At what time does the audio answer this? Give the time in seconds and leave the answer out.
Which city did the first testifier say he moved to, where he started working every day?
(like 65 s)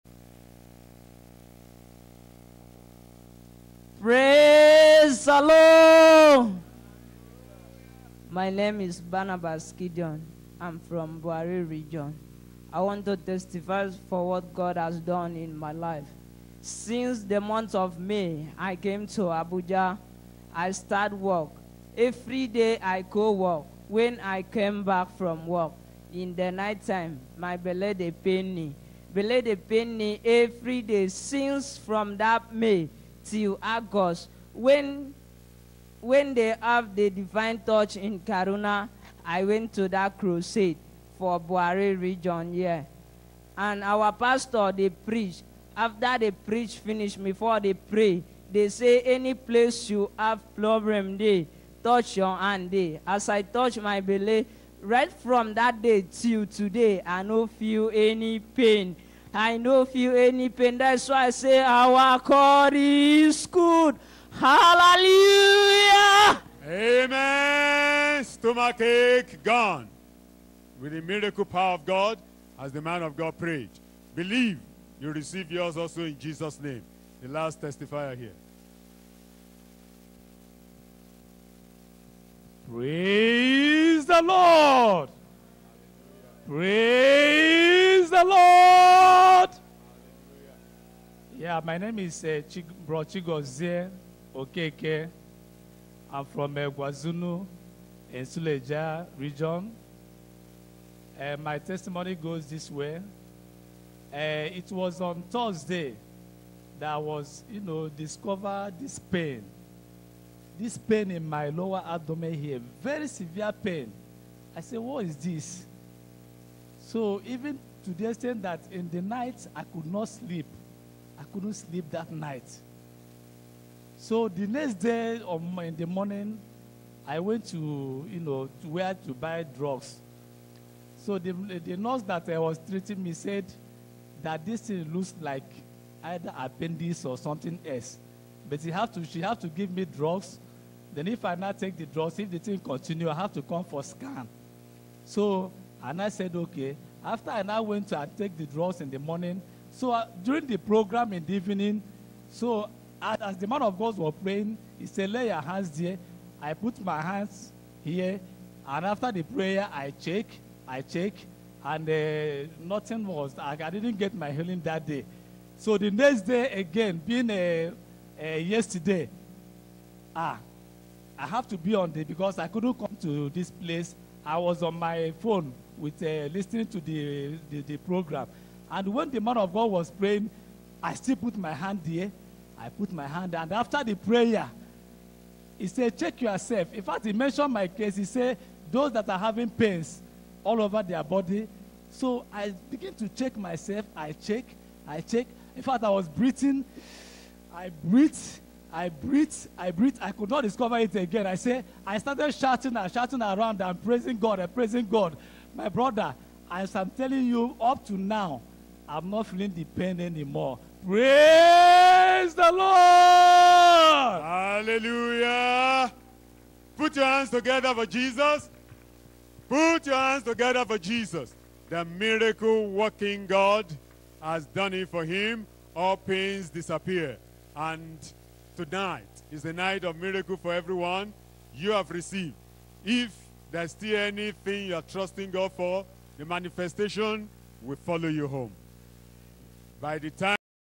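19 s.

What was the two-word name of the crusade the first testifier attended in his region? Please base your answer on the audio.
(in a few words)
Divine Touch.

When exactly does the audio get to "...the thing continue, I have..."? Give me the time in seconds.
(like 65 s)
142 s.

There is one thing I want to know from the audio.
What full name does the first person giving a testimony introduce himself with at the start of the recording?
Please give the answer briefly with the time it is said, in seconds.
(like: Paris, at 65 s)
Barnabas Gideon, at 8 s.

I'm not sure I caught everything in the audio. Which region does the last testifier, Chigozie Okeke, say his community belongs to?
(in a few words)
Suleja.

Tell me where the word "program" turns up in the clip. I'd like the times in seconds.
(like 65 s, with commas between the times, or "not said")
150 s, 177 s.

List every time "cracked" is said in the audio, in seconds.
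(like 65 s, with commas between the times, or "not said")
not said.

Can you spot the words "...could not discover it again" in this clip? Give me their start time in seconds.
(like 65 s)
200 s.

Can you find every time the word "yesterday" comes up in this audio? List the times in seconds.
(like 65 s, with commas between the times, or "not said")
168 s.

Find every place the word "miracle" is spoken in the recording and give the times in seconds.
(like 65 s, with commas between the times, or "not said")
71 s, 221 s, 229 s.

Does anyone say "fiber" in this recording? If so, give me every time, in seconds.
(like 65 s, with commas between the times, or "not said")
not said.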